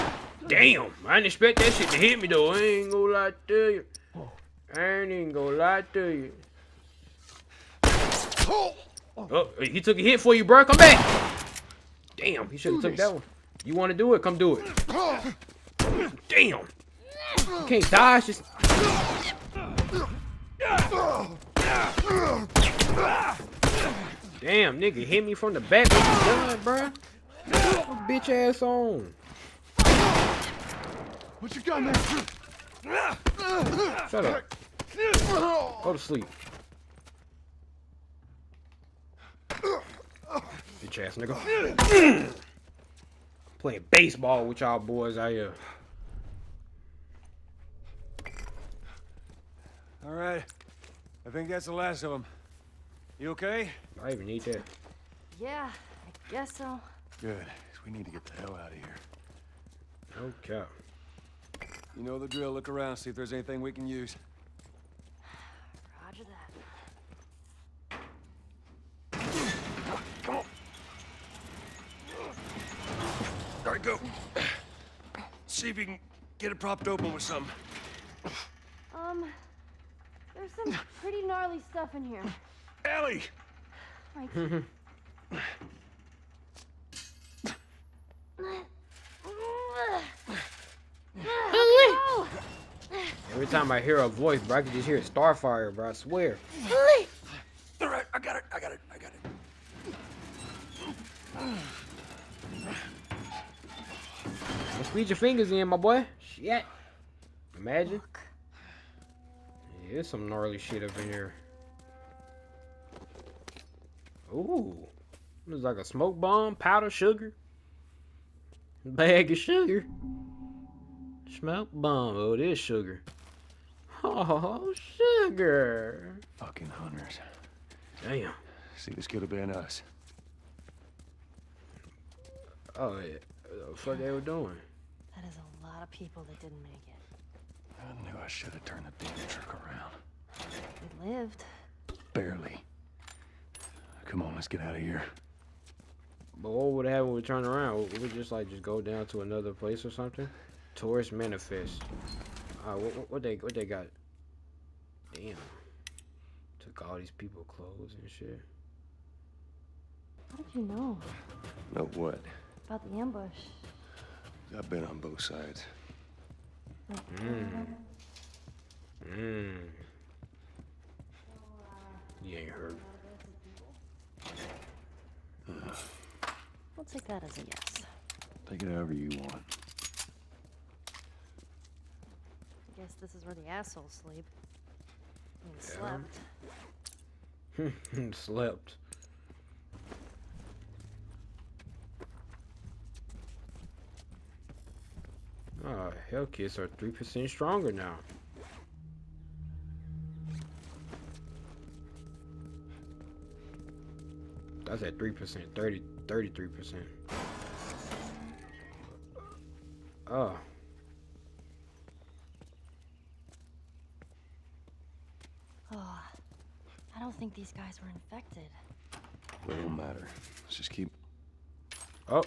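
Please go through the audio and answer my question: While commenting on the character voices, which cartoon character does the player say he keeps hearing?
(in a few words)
Starfire.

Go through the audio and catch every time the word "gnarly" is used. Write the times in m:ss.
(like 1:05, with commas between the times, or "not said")
1:21, 1:50.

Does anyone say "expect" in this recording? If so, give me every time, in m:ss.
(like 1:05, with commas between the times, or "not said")
0:01.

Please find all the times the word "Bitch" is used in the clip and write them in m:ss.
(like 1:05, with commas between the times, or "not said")
0:28, 0:39.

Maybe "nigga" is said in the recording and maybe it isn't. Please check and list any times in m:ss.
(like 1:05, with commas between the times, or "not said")
0:24, 0:41.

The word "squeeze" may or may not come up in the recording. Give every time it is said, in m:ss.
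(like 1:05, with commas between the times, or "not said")
1:44.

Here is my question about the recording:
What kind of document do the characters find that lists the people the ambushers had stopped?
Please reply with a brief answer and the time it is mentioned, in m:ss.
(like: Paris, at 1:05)
Tourist manifest, at 2:30.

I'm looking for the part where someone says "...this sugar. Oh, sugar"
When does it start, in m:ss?
2:02.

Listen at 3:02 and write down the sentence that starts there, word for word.
I guess this is where the assholes sleep.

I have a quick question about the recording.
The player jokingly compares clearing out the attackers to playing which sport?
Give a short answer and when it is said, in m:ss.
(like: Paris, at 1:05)
Baseball, at 0:43.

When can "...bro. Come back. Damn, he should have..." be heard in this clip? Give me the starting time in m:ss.
0:10.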